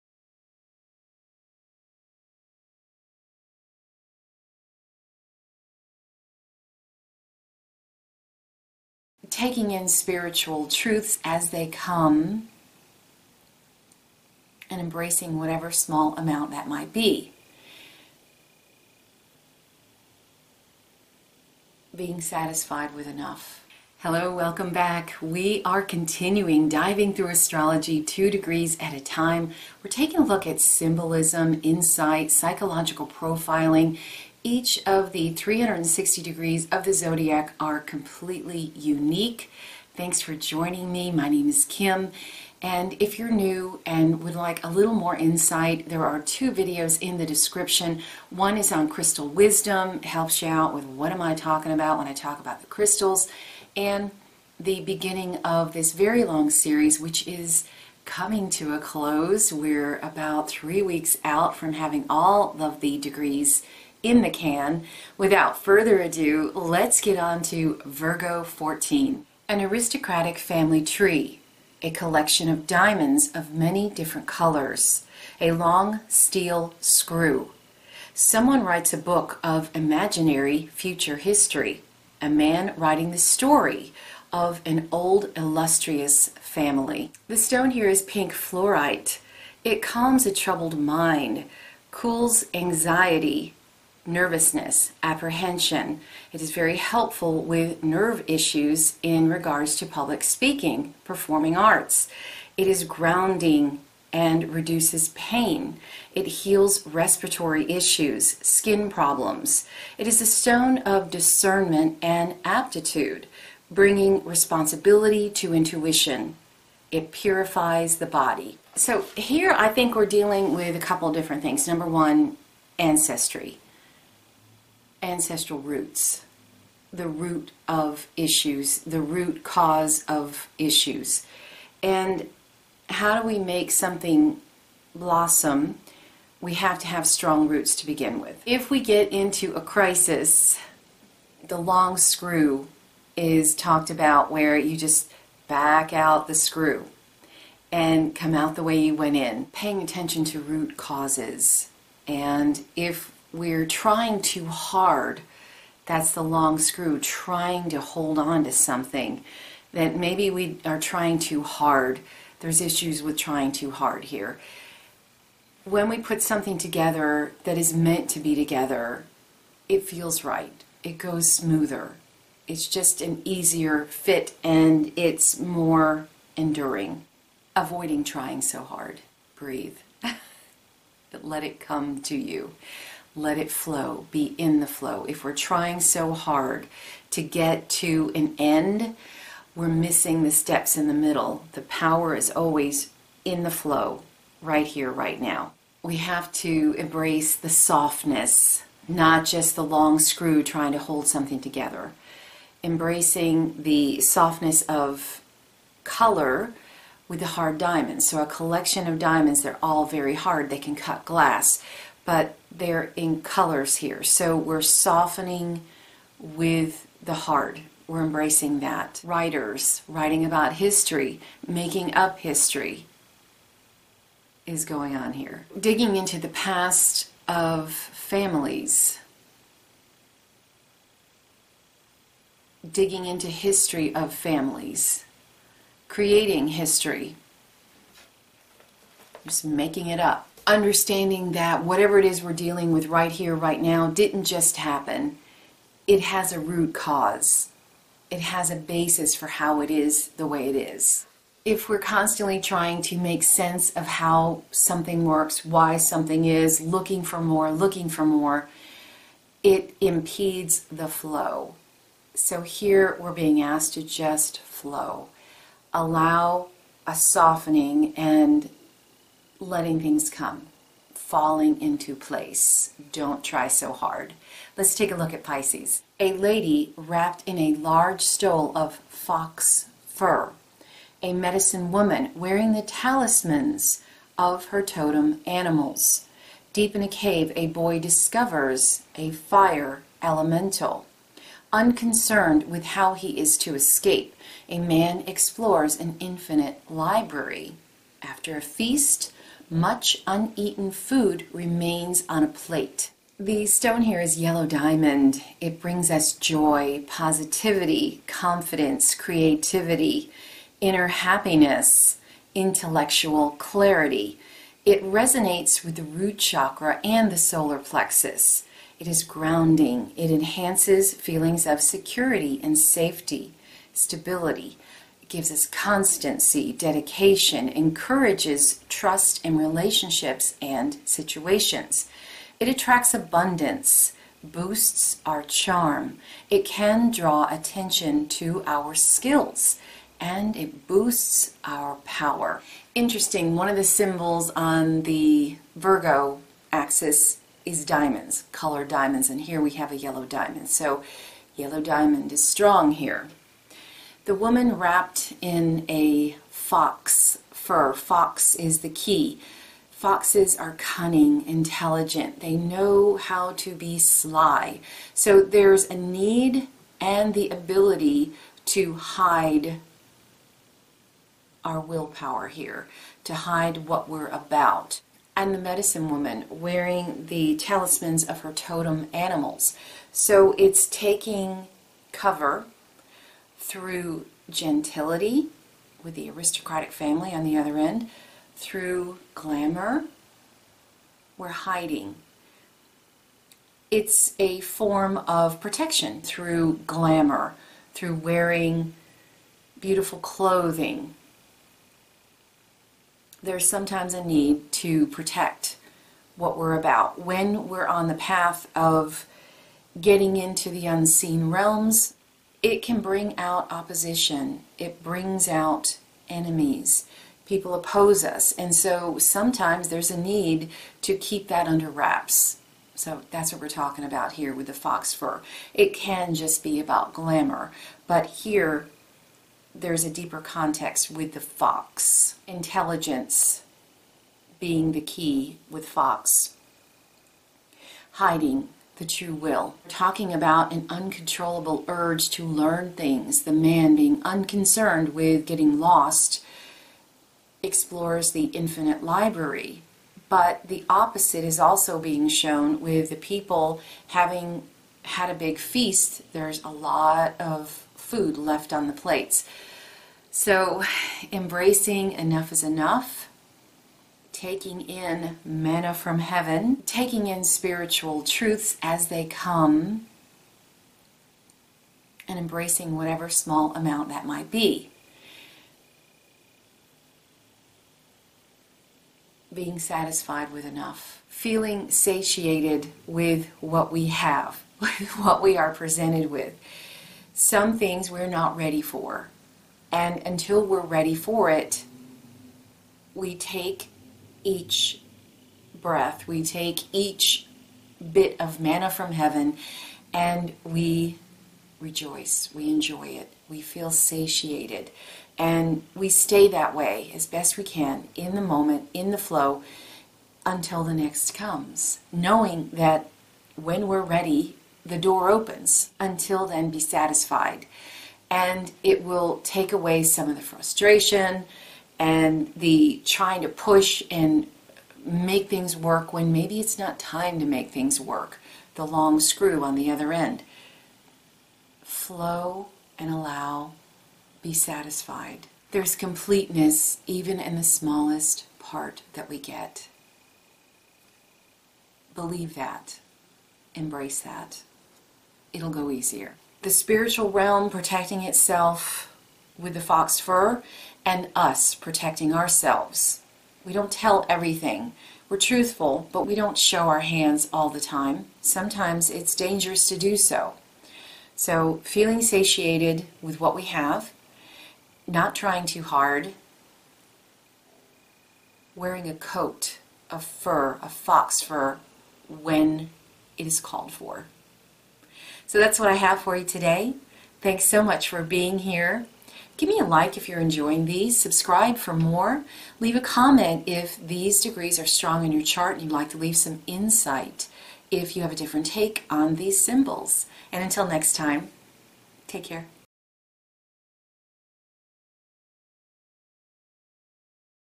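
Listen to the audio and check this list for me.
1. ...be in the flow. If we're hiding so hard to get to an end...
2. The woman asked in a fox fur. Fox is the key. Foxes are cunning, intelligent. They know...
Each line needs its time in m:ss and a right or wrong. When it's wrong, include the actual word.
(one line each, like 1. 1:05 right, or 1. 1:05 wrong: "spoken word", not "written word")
1. 3:04 wrong: "trying", not "hiding"
2. 5:54 wrong: "wrapped", not "asked".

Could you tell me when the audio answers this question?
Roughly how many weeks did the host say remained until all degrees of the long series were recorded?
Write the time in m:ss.
1:00.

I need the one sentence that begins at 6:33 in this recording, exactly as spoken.
It's a form of protection through glamour, through wearing beautiful clothing.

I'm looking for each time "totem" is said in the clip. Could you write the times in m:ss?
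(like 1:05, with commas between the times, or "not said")
4:44, 6:18.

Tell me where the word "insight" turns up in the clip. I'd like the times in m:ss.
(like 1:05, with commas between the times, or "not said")
0:31, 0:45, 9:46.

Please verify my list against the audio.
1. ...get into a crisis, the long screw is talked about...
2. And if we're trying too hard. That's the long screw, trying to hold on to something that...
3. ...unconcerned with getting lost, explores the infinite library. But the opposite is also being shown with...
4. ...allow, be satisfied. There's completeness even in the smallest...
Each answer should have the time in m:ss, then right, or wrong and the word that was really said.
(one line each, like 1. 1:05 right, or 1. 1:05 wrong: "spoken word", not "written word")
1. 2:18 right
2. 2:32 right
3. 7:24 right
4. 8:52 right.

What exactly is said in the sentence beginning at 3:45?
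Digging into the past of families.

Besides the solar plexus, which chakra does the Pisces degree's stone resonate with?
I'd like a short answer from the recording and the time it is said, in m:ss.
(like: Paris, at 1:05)
Root chakra, at 5:15.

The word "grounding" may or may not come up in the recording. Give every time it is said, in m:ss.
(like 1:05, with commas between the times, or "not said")
1:42, 5:19.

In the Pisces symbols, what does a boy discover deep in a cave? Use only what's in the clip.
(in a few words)
A fire elemental.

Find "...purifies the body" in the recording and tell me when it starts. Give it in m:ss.
1:57.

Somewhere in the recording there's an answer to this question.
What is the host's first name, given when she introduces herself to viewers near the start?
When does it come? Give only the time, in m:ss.
0:41.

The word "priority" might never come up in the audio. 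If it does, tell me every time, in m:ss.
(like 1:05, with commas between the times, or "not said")
not said.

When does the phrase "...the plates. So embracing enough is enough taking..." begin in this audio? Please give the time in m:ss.
7:38.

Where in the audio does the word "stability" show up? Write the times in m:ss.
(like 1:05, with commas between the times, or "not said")
5:23.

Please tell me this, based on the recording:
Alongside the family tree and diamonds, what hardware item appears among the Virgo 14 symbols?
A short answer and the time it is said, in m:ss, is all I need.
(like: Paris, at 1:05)
A long steel screw, at 1:15.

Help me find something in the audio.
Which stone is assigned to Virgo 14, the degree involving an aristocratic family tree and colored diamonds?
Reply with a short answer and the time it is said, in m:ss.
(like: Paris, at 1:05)
Pink fluorite, at 1:28.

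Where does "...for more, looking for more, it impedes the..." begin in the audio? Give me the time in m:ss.
4:17.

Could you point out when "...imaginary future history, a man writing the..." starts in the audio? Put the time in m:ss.
1:19.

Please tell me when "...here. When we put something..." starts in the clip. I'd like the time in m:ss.
2:44.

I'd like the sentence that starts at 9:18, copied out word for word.
Sometimes it's dangerous to do so.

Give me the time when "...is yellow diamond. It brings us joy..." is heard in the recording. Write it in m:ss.
5:03.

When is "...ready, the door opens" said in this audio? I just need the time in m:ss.
8:33.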